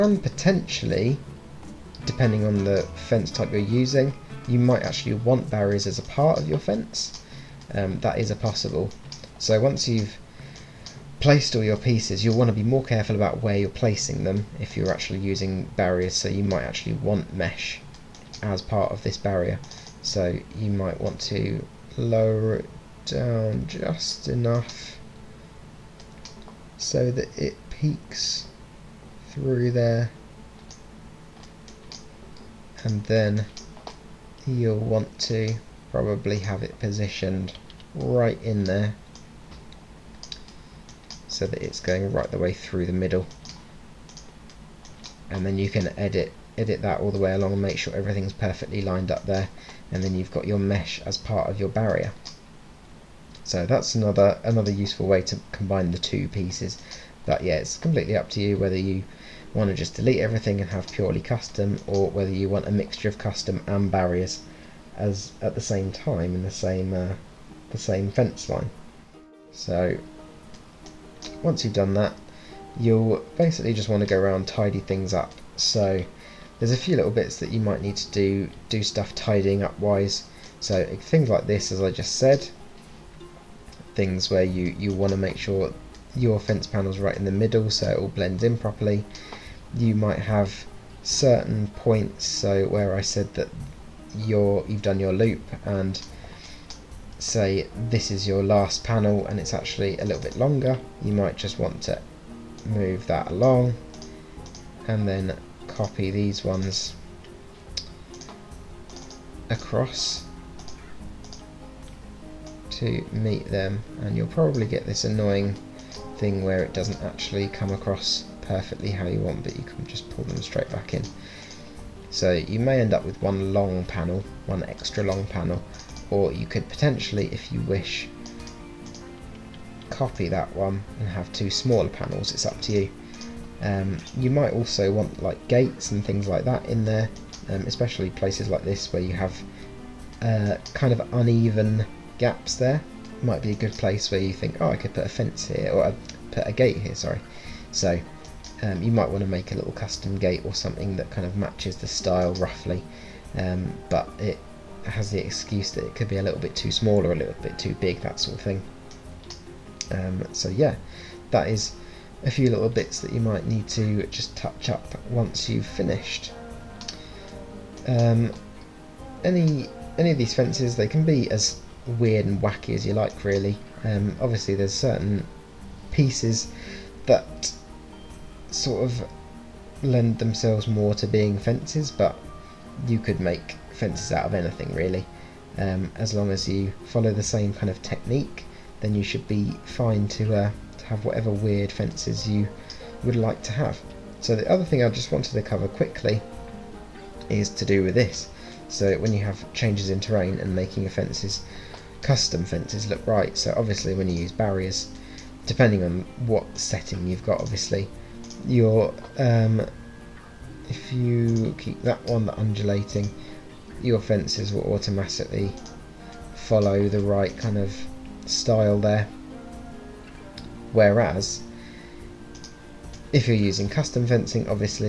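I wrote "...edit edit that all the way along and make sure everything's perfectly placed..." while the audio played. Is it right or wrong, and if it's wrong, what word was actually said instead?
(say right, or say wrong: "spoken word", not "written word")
wrong: "lined", not "placed".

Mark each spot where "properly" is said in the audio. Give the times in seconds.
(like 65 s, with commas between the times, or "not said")
88 s.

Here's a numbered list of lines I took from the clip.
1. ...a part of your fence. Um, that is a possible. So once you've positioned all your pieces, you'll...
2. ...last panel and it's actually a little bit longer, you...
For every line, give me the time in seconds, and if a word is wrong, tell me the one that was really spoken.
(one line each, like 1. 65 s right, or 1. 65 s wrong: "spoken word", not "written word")
1. 5 s wrong: "placed", not "positioned"
2. 98 s right.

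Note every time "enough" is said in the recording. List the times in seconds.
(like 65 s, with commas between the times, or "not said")
24 s.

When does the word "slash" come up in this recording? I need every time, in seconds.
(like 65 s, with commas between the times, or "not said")
not said.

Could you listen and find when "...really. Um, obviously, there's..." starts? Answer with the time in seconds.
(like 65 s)
173 s.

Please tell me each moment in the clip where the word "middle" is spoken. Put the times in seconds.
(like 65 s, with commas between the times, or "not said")
42 s, 87 s.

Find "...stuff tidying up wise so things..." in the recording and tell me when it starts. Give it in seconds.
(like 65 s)
78 s.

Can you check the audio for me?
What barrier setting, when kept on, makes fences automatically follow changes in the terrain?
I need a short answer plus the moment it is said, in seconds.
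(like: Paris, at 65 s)
undulating, at 212 s.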